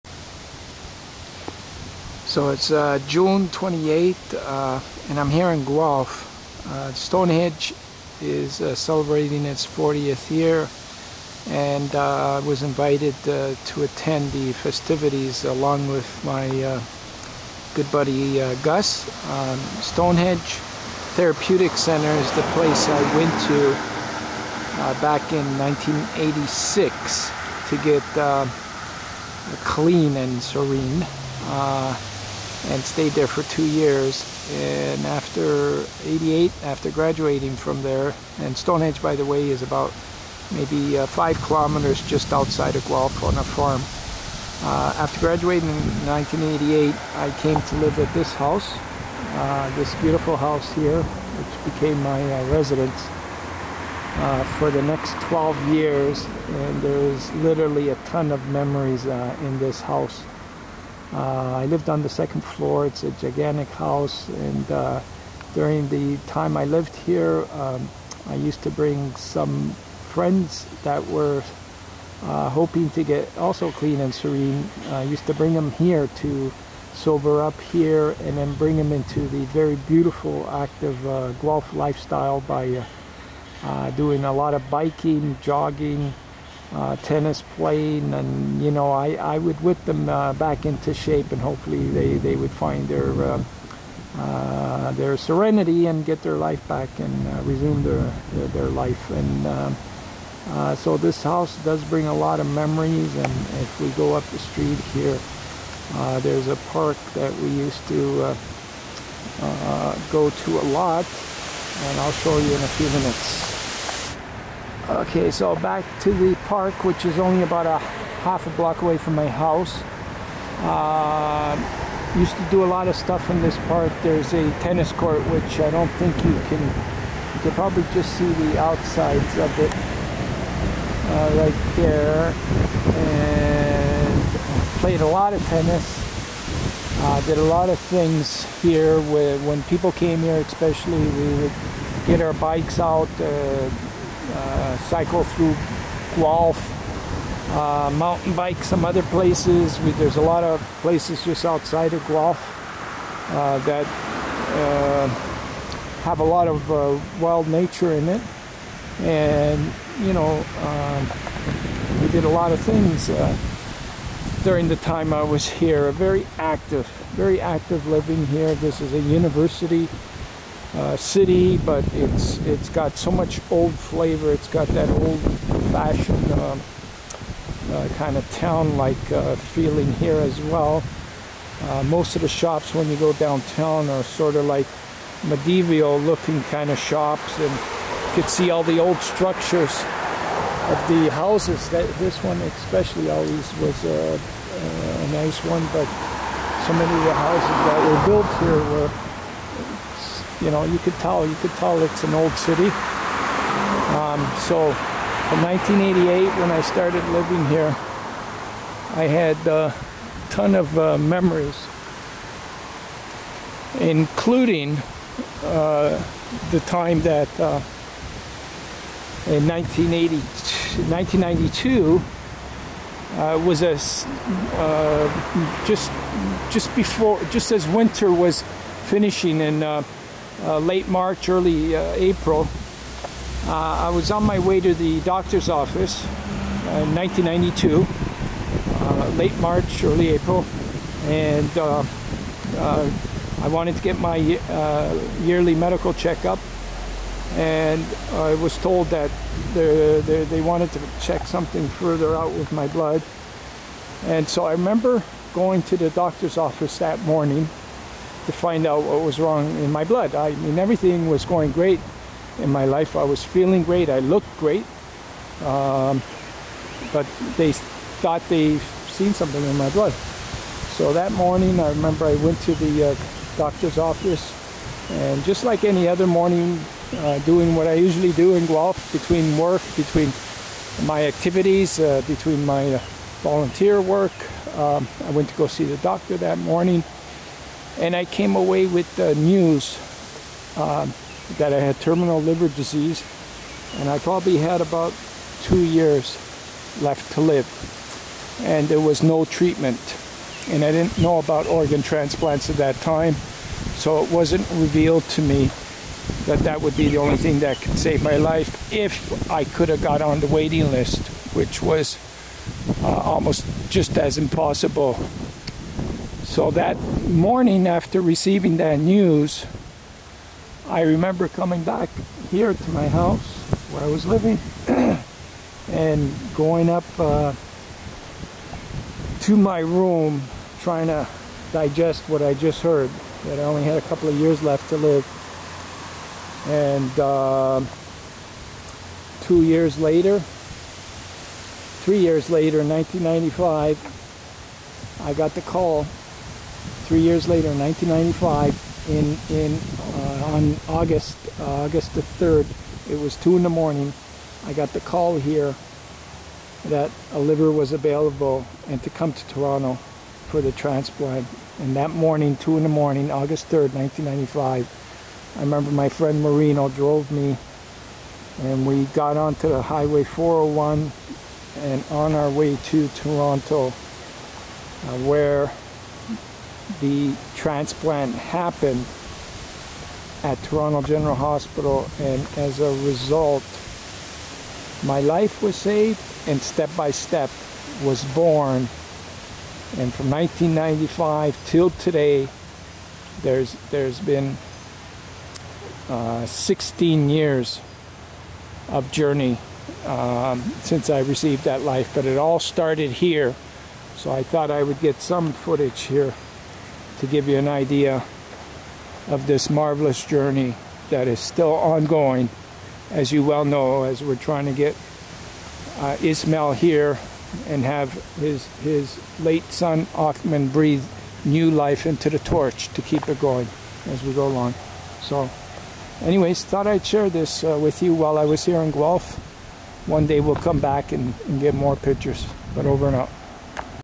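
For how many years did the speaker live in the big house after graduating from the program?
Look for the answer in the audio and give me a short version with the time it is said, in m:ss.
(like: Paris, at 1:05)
12 years, at 0:55.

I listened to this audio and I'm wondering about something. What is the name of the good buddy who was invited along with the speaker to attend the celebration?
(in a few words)
Gus.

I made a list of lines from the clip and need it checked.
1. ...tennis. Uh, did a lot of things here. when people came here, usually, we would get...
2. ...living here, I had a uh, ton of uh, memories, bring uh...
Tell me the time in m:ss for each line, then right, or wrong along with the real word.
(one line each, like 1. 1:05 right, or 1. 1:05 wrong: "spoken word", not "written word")
1. 2:15 wrong: "especially", not "usually"
2. 3:27 wrong: "including", not "bring".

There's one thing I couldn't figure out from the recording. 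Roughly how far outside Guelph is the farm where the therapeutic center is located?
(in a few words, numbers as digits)
5 kilometers.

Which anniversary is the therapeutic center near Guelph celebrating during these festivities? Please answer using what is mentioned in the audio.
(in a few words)
40th year.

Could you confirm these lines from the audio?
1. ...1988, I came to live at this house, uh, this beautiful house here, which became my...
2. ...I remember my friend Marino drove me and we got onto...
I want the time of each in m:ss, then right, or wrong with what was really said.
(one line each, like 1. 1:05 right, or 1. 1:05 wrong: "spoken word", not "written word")
1. 0:46 right
2. 6:05 right.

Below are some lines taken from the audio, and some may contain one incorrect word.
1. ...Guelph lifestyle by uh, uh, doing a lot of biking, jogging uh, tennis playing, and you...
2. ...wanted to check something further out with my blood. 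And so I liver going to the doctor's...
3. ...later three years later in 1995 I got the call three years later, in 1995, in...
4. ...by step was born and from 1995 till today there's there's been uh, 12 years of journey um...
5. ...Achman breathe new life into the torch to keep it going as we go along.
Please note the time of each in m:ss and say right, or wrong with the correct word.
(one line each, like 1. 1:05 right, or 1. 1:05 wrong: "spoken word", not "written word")
1. 1:21 right
2. 4:10 wrong: "remember", not "liver"
3. 5:39 right
4. 6:26 wrong: "16", not "12"
5. 6:59 right.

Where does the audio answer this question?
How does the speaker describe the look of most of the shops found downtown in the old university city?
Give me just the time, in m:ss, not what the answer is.
3:05.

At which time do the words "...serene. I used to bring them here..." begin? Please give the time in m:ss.
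1:14.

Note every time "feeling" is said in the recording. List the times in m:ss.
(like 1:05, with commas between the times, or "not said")
2:59, 4:23.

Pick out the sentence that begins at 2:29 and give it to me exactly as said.
We, there's a lot of places just outside of Guelph uh, that uh, have a lot of uh, wild nature in it.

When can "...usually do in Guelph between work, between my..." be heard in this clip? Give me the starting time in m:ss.
4:37.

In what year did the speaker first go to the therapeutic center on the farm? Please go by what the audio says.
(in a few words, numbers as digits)
1986.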